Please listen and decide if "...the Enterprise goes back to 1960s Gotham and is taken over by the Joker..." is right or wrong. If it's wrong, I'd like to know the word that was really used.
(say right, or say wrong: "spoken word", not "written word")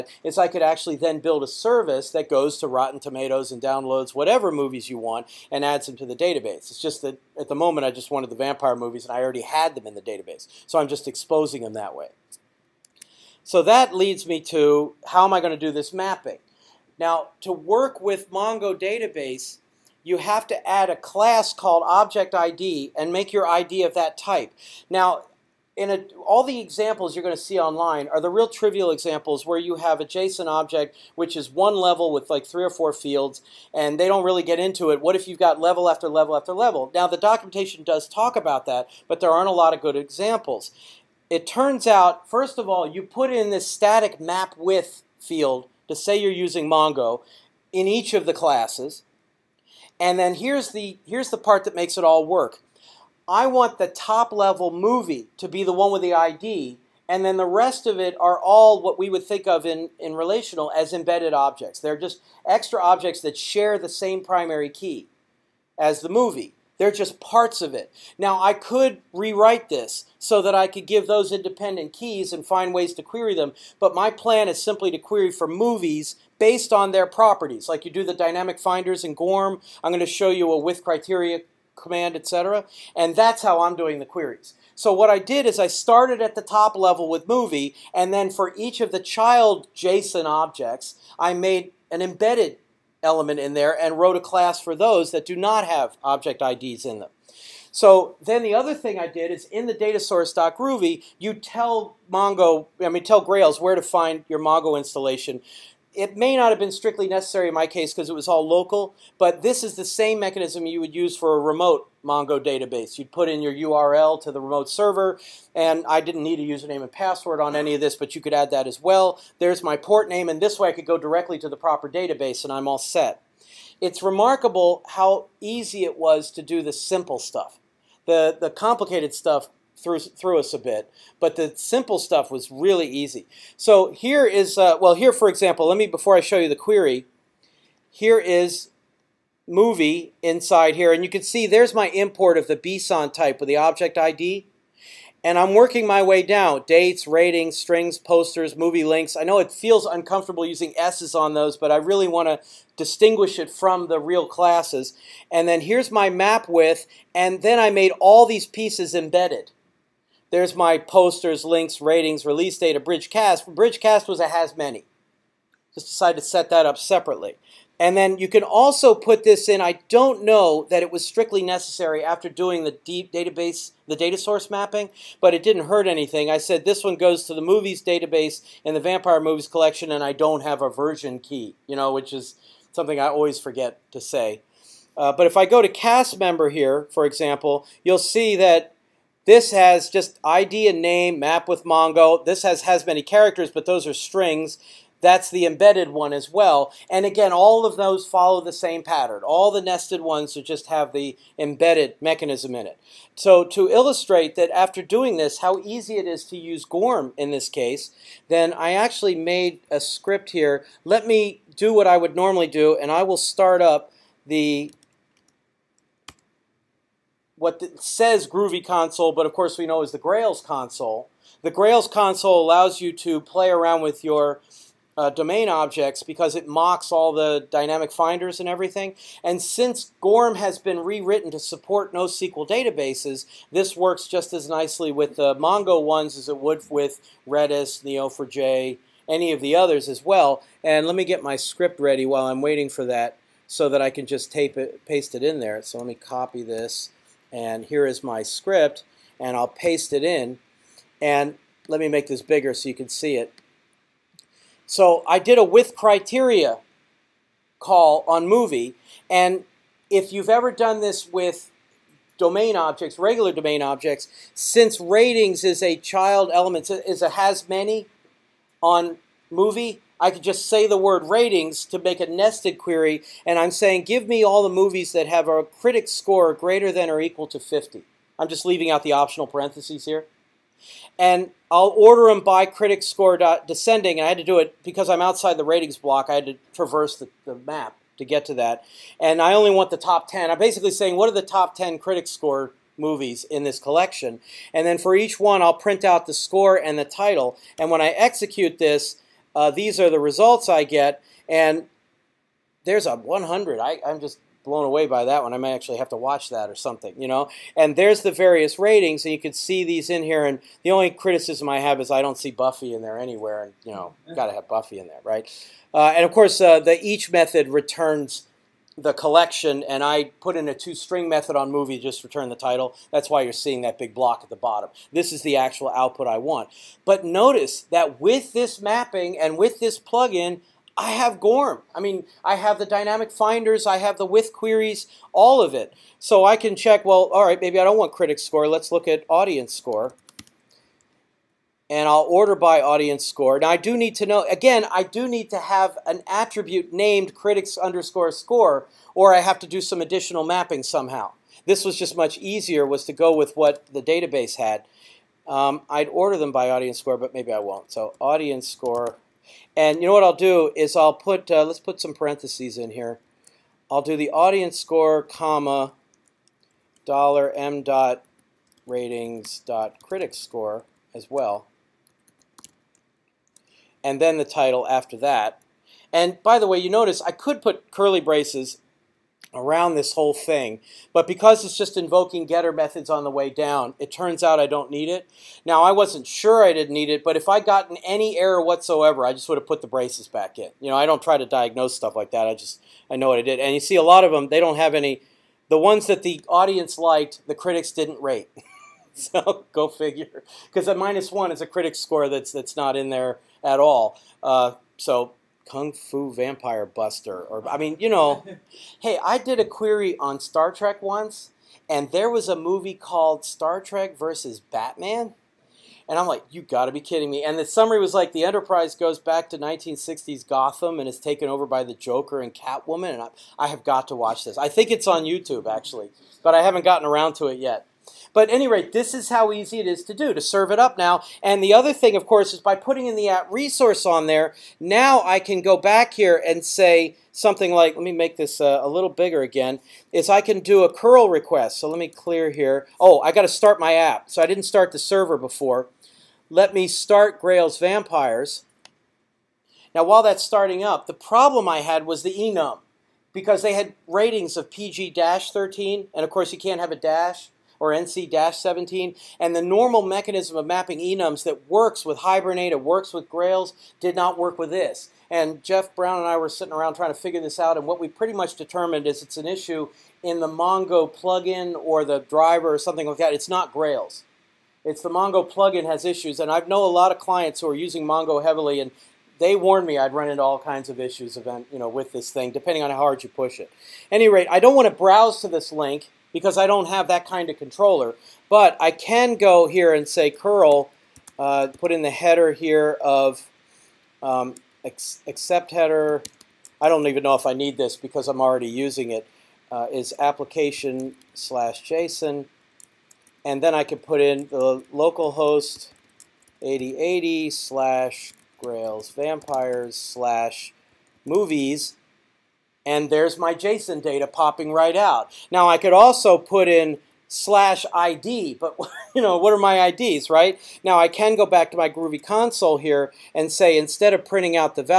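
right.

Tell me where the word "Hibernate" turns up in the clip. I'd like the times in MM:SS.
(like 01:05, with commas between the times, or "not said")
07:41.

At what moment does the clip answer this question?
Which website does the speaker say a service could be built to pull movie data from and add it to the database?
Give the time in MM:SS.
00:02.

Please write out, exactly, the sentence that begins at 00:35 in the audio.
What if you've got level after level after level?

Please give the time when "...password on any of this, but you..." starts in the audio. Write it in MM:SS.
01:56.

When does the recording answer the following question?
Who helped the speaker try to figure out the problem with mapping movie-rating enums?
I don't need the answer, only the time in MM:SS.
07:45.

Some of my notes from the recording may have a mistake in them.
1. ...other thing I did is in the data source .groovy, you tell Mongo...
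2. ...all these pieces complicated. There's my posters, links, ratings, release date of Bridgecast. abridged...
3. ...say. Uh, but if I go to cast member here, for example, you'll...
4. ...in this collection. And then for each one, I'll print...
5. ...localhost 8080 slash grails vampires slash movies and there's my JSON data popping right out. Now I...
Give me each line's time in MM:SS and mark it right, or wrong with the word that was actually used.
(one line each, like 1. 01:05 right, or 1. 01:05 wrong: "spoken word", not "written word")
1. 01:38 right
2. 02:38 wrong: "embedded", not "complicated"
3. 03:04 right
4. 04:53 right
5. 08:24 right.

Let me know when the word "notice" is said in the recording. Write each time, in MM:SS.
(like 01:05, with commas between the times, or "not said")
05:27, 06:16.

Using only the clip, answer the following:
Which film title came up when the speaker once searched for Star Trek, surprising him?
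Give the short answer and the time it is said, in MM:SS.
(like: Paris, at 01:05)
Star Trek versus Batman, at 06:53.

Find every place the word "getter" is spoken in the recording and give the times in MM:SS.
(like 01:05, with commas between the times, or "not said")
06:22.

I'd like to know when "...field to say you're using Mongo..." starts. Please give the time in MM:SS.
00:45.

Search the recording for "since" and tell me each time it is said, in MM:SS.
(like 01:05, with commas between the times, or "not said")
03:49, 04:24.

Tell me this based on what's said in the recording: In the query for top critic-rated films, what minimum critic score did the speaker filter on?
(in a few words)
50.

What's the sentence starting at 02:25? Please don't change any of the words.
And I'm working my way down.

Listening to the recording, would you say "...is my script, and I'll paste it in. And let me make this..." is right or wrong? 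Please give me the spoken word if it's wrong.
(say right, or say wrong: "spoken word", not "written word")
right.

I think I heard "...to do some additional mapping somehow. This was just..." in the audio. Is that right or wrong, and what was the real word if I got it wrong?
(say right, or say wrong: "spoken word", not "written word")
right.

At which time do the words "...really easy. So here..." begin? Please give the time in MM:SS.
02:12.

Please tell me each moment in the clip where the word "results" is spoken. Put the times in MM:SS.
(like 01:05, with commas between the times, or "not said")
04:59.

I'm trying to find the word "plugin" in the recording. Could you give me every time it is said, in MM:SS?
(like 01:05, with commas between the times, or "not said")
05:29, 07:50, 07:55.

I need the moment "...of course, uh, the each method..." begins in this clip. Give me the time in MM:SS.
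05:16.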